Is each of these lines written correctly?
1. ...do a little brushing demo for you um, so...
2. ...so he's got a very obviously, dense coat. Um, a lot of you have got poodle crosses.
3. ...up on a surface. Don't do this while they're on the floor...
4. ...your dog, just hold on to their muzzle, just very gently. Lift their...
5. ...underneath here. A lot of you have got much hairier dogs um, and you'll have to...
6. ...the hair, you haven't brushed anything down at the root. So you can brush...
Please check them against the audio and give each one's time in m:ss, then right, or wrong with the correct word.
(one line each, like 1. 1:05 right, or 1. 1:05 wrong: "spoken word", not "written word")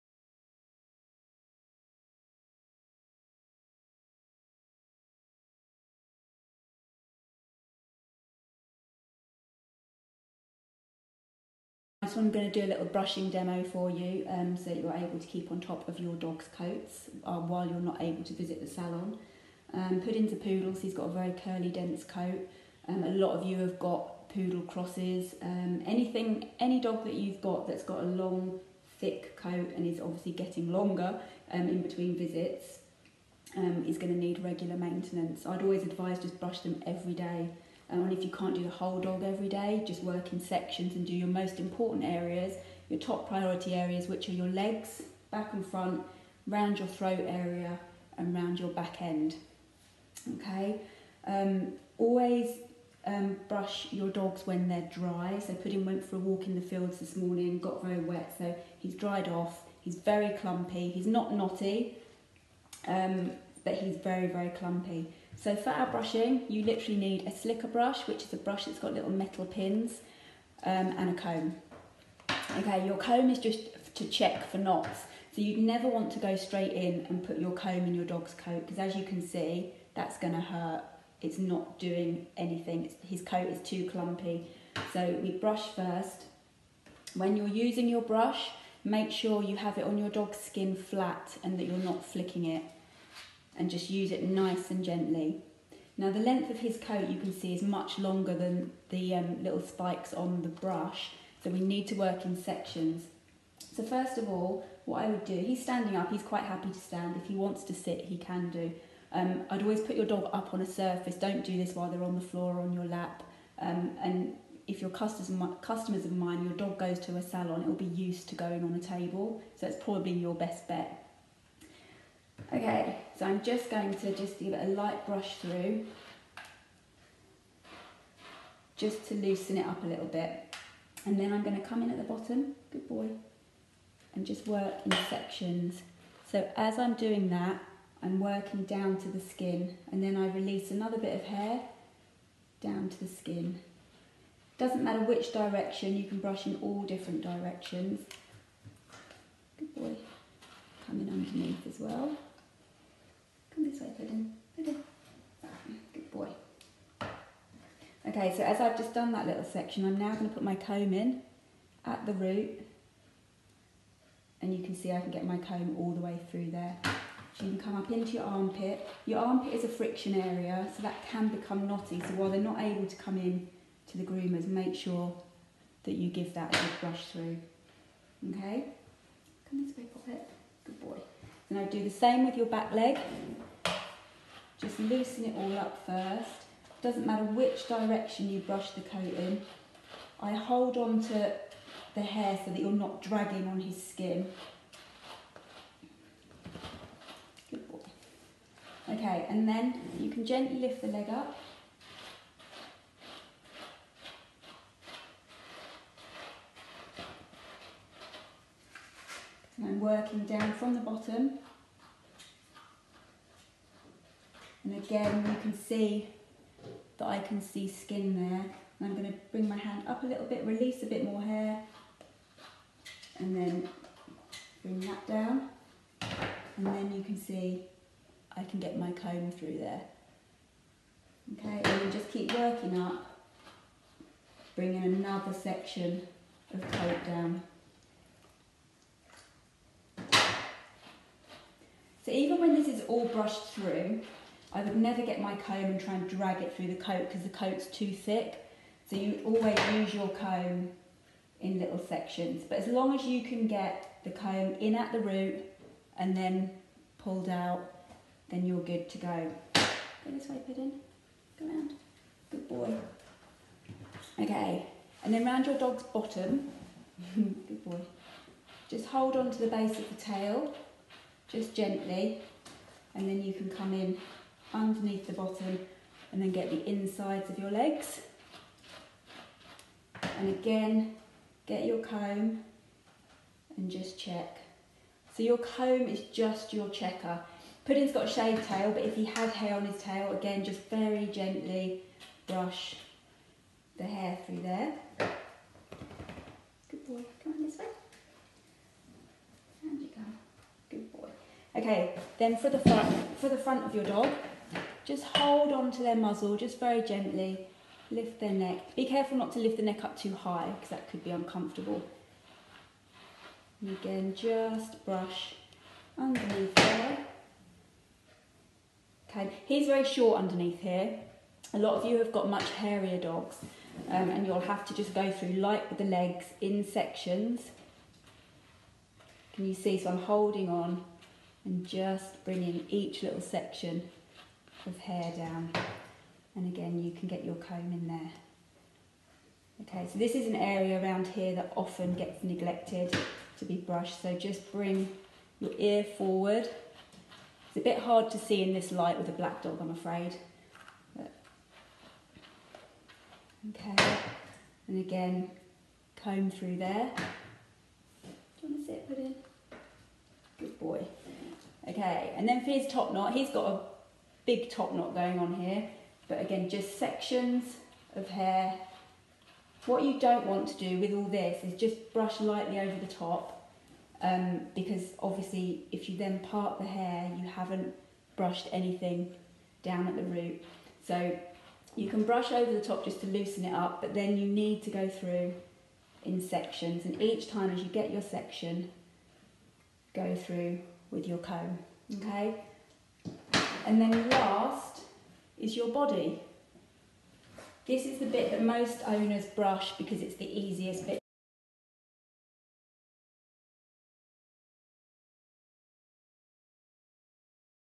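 1. 0:12 right
2. 0:20 wrong: "curly", not "obviously"
3. 1:50 right
4. 5:03 right
5. 5:20 right
6. 6:16 right.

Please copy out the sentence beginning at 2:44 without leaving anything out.
And you can see I can get my comb all the way through there.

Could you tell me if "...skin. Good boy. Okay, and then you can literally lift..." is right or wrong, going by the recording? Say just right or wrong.
wrong.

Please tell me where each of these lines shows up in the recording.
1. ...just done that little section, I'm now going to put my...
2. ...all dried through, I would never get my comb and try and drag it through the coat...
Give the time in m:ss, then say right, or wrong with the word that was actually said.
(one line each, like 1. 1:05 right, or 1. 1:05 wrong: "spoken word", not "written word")
1. 2:38 right
2. 4:02 wrong: "brushed", not "dried".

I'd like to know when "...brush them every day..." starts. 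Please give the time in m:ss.
0:36.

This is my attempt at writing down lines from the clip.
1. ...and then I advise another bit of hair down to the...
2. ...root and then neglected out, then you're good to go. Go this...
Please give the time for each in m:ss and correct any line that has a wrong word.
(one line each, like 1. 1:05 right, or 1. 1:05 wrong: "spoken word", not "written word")
1. 2:19 wrong: "release", not "advise"
2. 4:14 wrong: "pulled", not "neglected".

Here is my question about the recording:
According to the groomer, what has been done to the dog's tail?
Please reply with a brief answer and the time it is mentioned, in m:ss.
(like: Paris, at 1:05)
Shaved, at 4:48.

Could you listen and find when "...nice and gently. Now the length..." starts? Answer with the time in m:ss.
1:34.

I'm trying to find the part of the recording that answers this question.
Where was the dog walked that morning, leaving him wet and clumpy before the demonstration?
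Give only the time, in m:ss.
0:56.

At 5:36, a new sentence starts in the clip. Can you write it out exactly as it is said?
And again, you can get your comb in there.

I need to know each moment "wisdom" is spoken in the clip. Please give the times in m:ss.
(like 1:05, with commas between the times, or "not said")
not said.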